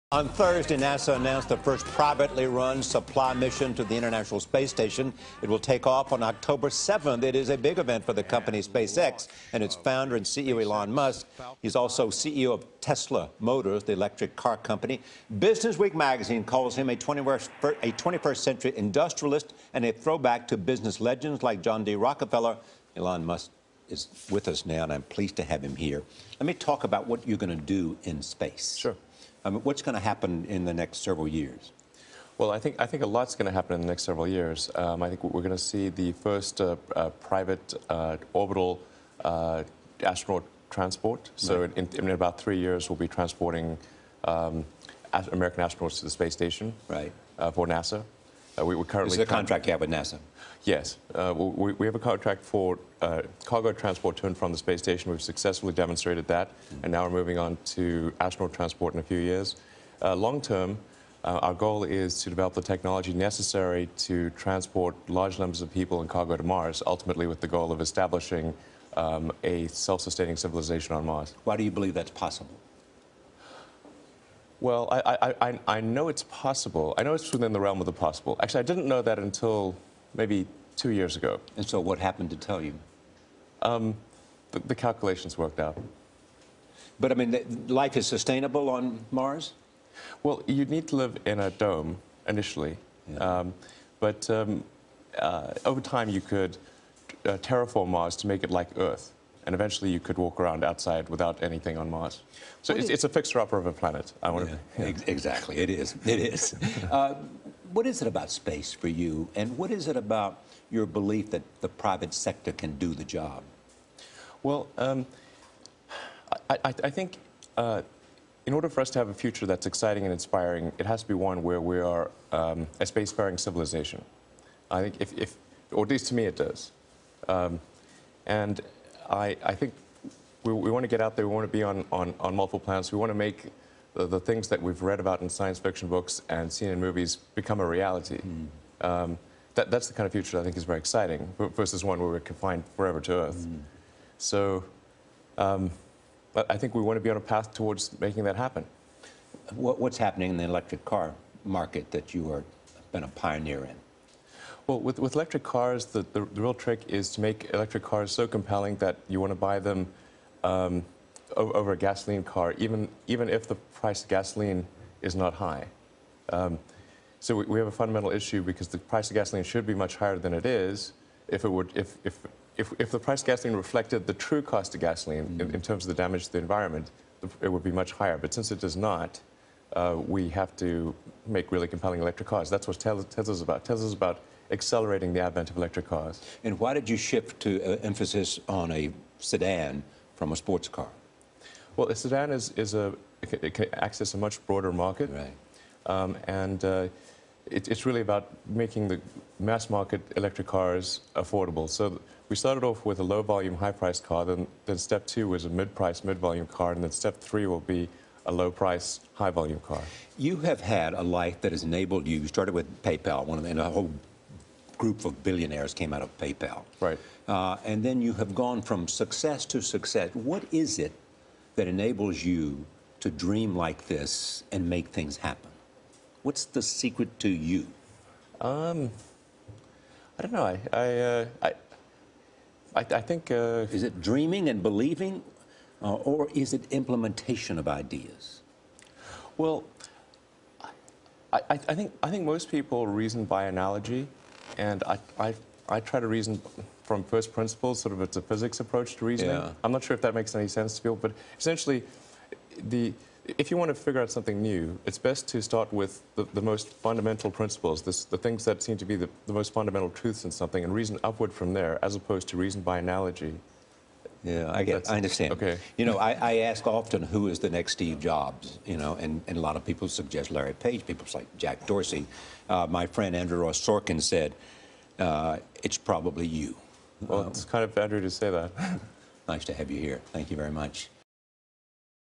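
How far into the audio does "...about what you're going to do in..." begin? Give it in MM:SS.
00:26.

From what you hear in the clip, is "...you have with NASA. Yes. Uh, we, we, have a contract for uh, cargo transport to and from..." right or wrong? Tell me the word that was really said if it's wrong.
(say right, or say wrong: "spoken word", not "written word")
right.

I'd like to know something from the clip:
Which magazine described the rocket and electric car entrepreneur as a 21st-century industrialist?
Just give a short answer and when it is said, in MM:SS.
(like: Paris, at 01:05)
Business Week, at 00:15.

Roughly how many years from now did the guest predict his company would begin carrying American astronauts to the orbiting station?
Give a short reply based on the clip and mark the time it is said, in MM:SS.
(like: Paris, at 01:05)
3 years, at 00:42.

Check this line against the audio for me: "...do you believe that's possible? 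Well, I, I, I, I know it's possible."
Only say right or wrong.
right.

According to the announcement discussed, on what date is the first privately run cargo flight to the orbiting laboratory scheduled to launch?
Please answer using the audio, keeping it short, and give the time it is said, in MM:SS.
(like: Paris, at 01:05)
October 7th, at 00:06.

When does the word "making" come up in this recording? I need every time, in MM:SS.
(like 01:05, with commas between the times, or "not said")
02:27, 03:18.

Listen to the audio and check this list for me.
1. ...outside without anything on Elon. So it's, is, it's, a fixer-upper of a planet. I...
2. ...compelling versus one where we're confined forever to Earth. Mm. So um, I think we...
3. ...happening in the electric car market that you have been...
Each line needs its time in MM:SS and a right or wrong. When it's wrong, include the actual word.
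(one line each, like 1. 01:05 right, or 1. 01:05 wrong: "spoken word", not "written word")
1. 01:40 wrong: "Mars", not "Elon"
2. 02:20 wrong: "exciting", not "compelling"
3. 02:29 right.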